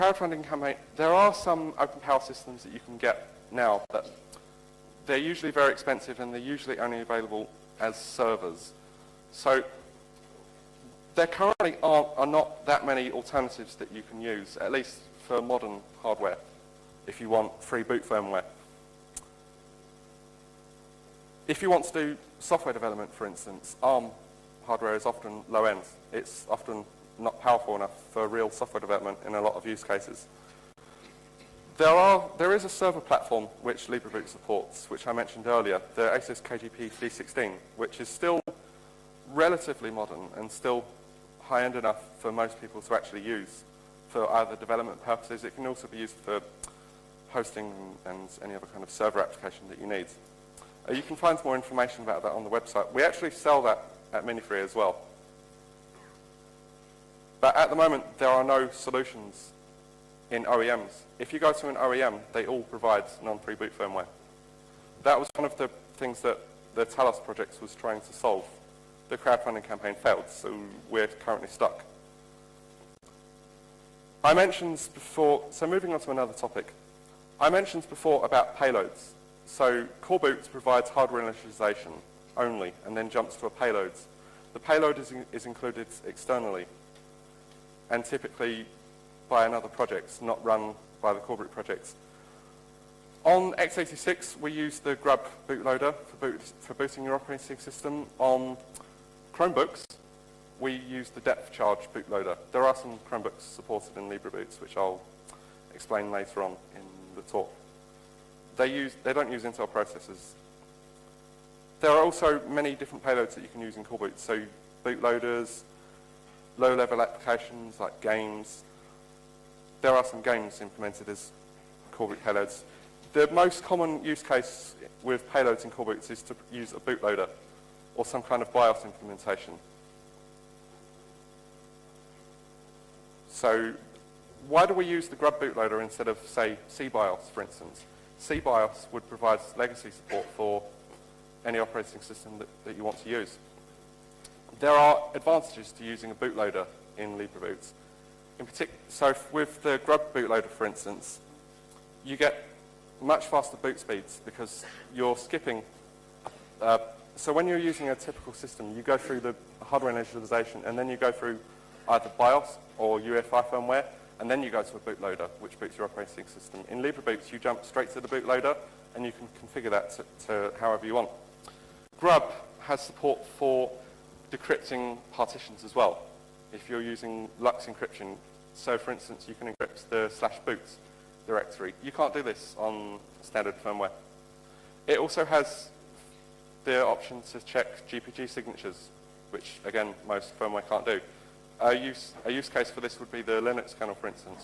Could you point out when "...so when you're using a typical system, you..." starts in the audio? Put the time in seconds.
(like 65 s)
157 s.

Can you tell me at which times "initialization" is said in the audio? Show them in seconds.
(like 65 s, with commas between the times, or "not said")
81 s, 159 s.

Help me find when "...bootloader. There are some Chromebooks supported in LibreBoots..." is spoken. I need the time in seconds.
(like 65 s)
101 s.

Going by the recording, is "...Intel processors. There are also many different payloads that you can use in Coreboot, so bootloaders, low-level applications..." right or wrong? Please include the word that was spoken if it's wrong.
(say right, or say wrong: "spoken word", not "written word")
right.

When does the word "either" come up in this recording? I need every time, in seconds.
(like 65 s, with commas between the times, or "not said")
44 s, 161 s.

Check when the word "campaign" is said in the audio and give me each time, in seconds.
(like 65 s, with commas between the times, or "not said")
0 s, 69 s.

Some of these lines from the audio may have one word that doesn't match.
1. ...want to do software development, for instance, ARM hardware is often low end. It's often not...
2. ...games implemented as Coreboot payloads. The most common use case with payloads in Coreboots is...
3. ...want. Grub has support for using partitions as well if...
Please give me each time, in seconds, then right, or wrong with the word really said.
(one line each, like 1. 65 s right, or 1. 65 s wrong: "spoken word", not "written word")
1. 21 s right
2. 120 s right
3. 170 s wrong: "decrypting", not "using".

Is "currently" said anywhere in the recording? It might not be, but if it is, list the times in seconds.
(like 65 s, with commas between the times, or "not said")
11 s, 71 s.